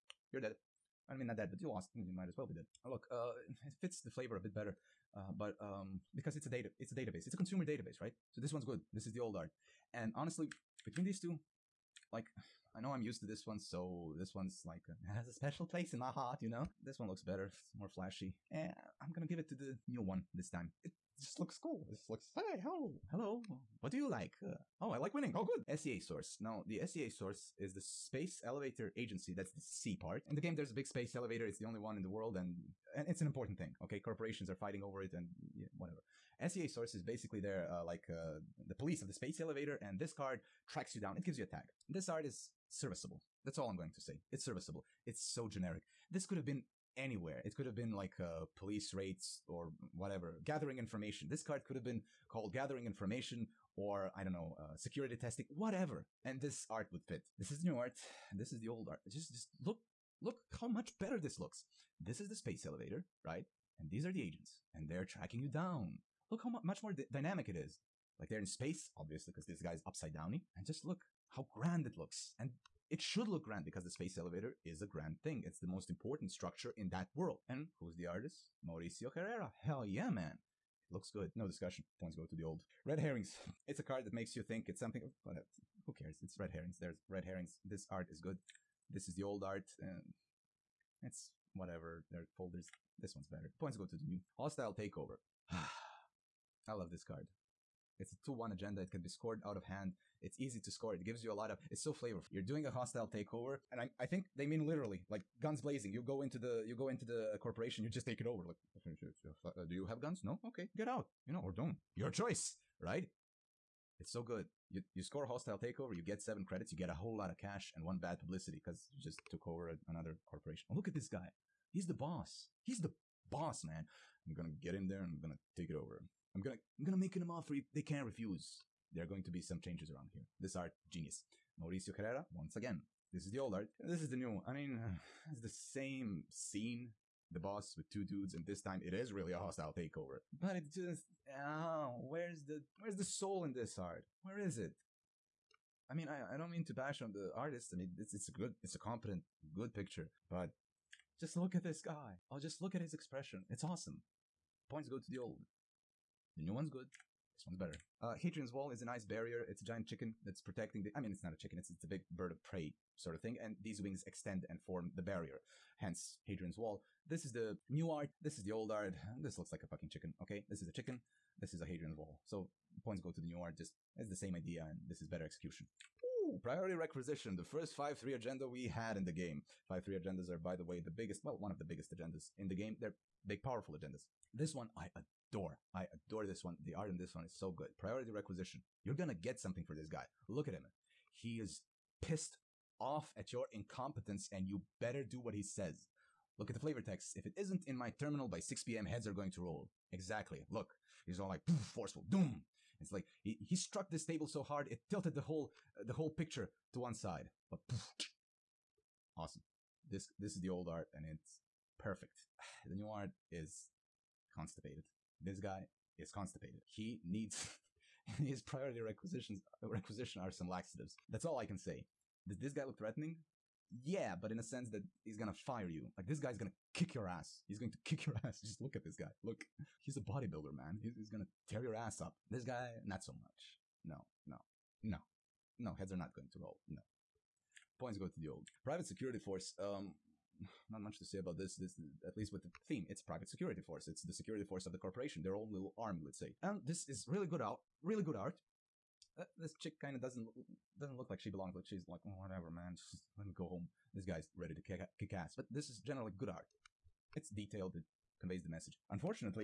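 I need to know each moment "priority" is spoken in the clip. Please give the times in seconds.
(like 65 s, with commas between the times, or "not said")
176 s, 187 s, 218 s.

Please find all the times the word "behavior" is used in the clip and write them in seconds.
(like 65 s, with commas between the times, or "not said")
not said.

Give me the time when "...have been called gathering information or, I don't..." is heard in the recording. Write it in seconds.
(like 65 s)
51 s.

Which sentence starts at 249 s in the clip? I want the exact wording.
Uh, this chick kind of doesn't doesn't look like she belongs.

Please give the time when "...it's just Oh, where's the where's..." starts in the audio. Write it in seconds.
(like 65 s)
140 s.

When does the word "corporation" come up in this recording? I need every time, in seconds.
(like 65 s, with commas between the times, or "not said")
33 s, 107 s, 120 s, 244 s.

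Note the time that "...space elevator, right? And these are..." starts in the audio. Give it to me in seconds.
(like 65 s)
62 s.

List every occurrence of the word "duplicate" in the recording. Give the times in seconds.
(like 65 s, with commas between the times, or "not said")
not said.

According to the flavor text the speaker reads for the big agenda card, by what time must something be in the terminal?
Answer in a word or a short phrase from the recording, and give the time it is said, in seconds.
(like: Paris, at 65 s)
6 p.m., at 198 s.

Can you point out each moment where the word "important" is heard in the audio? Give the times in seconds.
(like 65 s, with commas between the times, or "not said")
33 s, 75 s.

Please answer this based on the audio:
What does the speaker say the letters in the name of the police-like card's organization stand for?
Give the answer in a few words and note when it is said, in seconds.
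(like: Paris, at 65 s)
Space Elevator Agency, at 27 s.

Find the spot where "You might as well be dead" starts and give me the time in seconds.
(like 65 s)
1 s.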